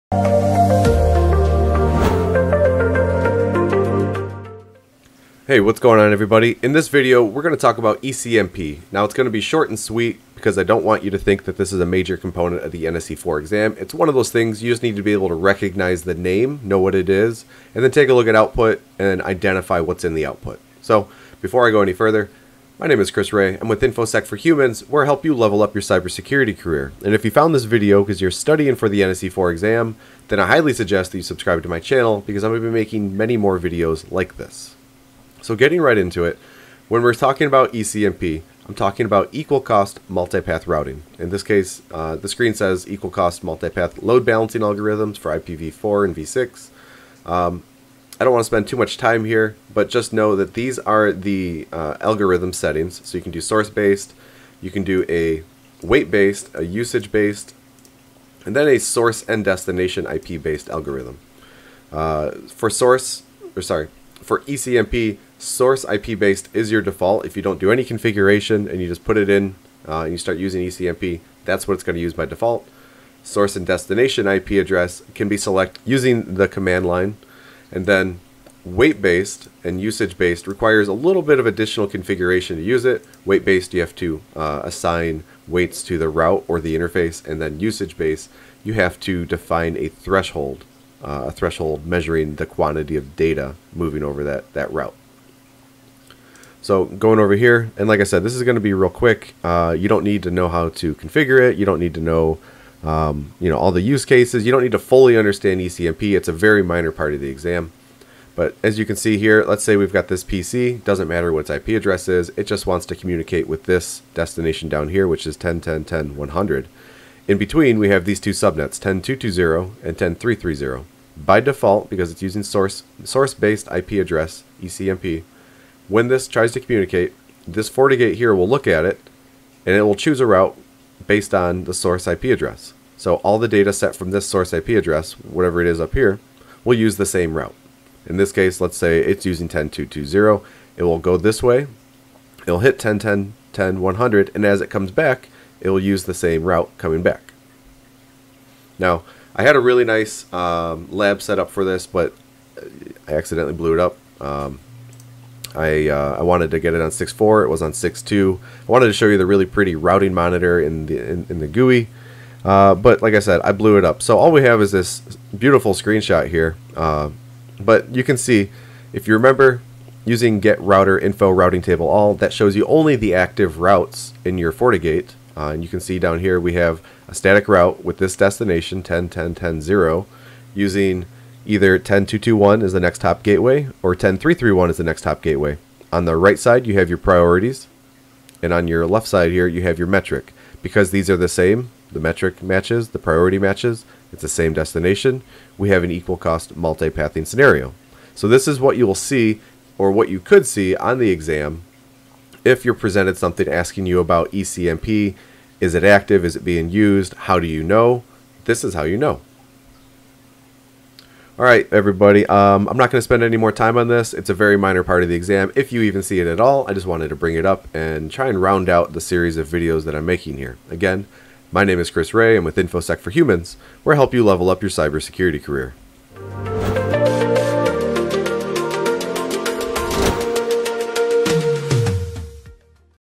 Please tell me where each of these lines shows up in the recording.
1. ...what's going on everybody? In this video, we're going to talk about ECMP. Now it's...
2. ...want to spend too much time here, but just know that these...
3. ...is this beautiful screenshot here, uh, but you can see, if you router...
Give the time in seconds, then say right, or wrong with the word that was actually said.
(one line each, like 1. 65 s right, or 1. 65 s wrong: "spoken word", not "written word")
1. 5 s right
2. 48 s right
3. 164 s wrong: "remember", not "router".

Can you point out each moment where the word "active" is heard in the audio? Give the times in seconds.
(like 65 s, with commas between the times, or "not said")
173 s, 205 s.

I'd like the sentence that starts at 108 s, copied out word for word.
But as you can see here, let's say we've got this PC.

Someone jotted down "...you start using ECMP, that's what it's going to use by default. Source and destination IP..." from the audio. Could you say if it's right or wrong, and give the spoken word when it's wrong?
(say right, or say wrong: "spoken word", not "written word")
right.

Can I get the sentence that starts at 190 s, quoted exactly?
Because these are the same, the metric matches, the priority matches, it's the same destination, we have an equal cost multipathing scenario.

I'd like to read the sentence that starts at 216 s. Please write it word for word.
I just wanted to bring it up and try and round out the series of videos that I'm making here.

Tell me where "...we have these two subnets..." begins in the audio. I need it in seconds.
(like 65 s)
117 s.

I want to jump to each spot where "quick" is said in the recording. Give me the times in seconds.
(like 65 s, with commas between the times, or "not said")
98 s.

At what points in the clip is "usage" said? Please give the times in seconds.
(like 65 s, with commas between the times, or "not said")
56 s, 79 s, 87 s.